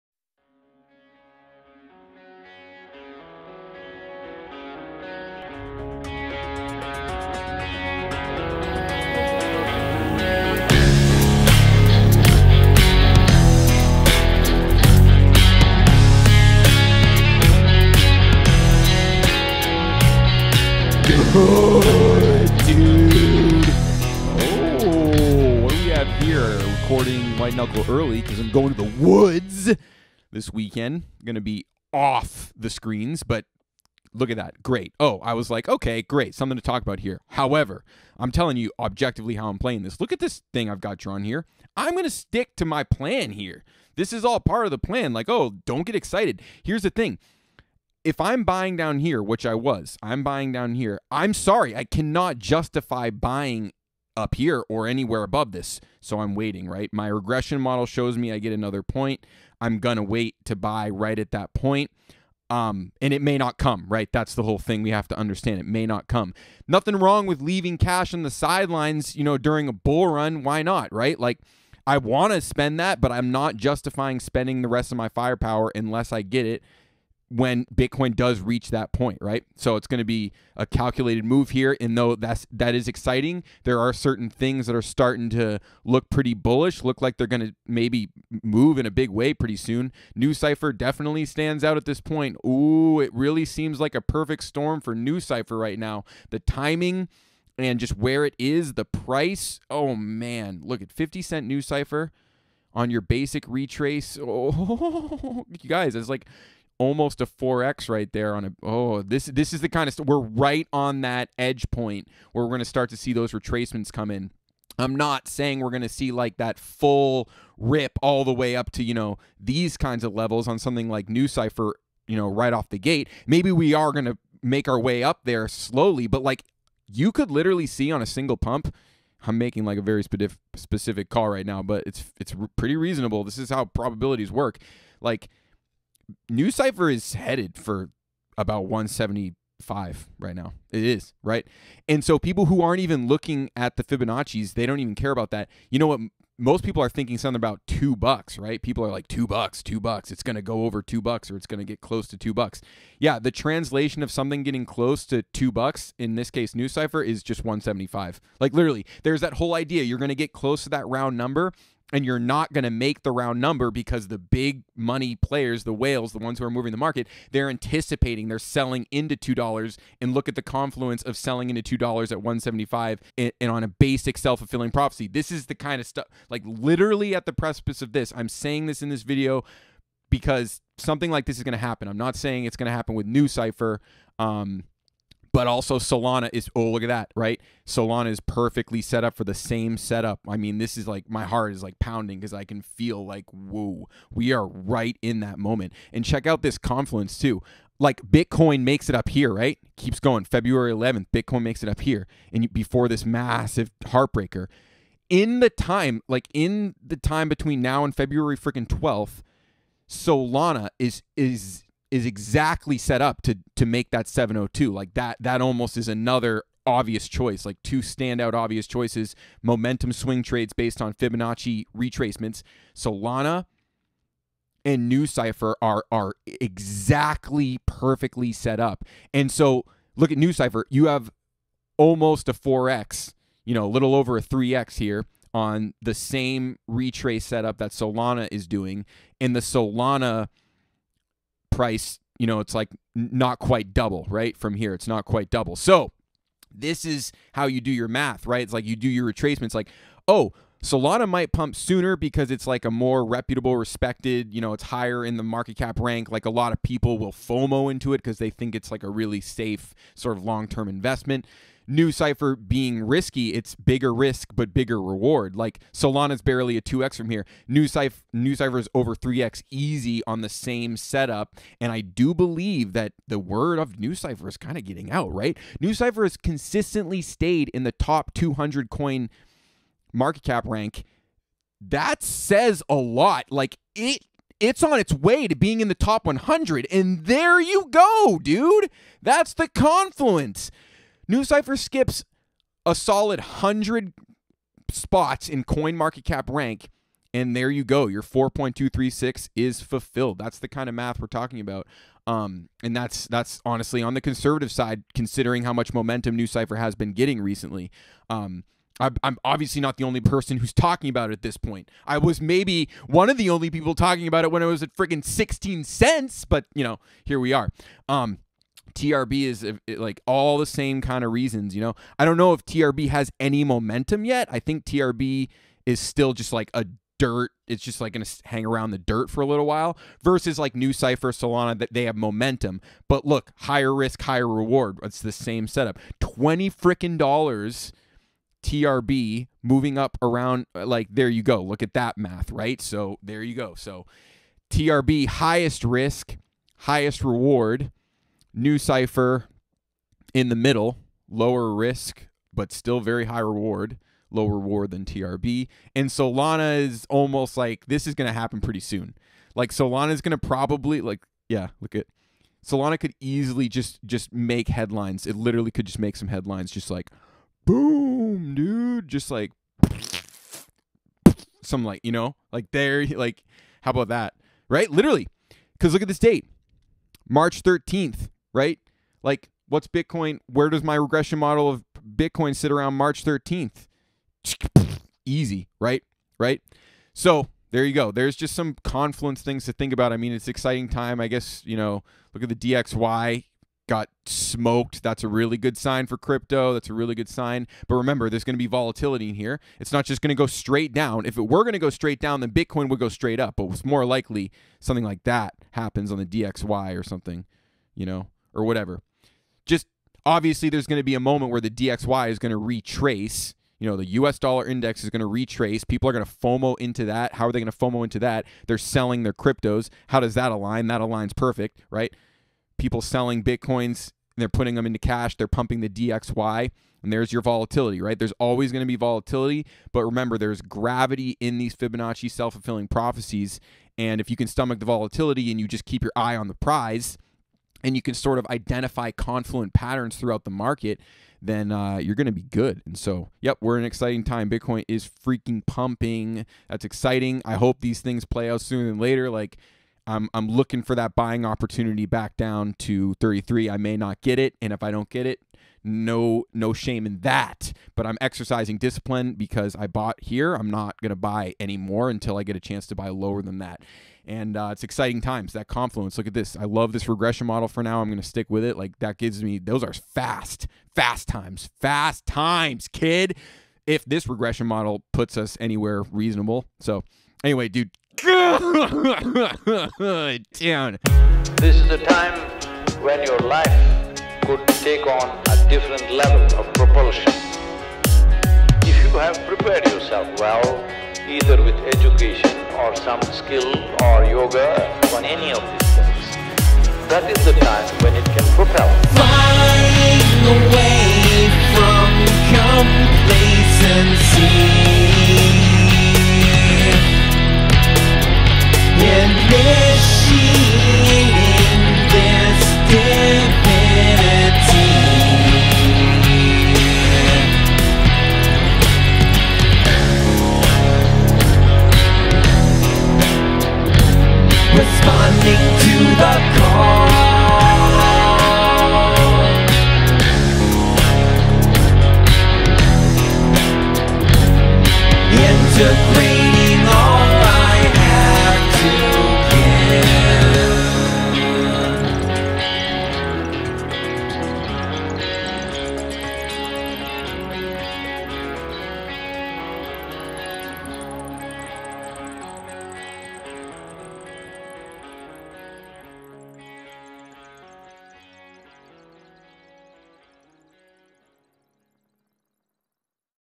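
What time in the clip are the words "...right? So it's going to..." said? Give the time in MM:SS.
01:19.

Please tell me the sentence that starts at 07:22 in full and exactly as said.
And so, yep, we're in an exciting time.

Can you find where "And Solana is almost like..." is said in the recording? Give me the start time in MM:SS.
05:55.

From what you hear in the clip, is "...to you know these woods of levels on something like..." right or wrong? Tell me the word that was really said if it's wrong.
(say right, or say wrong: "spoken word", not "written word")
wrong: "kinds", not "woods".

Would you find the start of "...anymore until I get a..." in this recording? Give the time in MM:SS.
07:41.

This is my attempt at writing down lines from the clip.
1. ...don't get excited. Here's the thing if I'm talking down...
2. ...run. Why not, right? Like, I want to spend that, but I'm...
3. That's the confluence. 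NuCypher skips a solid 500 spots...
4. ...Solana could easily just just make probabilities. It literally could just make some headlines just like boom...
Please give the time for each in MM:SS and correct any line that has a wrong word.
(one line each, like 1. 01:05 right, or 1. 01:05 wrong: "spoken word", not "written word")
1. 00:45 wrong: "buying", not "talking"
2. 01:10 right
3. 04:49 wrong: "100", not "500"
4. 06:02 wrong: "headlines", not "probabilities".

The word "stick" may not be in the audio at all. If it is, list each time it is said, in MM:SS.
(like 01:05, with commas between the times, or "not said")
00:42, 07:48.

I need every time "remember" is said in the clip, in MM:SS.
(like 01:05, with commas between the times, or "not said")
06:37, 07:09.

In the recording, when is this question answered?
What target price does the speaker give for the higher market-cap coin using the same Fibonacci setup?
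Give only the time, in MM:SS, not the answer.
03:34.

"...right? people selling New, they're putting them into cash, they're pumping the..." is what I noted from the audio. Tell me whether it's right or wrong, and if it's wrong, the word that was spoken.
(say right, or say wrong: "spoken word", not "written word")
wrong: "Bitcoins", not "New".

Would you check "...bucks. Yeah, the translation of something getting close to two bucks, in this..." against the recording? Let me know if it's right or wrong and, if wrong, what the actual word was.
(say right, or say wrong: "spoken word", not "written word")
right.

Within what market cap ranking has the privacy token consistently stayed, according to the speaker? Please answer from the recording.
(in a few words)
Top 200.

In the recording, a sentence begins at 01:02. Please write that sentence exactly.
Um, and it may not come, right?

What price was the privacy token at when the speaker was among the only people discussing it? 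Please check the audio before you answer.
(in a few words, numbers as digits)
16 cents.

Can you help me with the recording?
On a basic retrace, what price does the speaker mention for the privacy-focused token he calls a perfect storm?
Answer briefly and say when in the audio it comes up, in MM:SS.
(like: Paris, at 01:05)
50 cents, at 01:40.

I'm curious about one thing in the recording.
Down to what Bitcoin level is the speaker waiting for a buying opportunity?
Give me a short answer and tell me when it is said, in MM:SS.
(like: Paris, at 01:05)
33, at 07:32.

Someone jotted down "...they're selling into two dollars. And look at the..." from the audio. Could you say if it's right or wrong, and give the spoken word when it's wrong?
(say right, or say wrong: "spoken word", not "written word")
right.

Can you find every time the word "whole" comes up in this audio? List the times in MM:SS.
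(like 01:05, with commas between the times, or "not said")
01:04, 02:39.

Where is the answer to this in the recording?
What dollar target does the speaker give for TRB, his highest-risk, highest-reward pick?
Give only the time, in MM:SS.
05:35.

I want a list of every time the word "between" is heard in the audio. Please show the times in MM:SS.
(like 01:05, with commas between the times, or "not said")
03:27.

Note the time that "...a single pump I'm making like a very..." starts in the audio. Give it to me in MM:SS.
02:08.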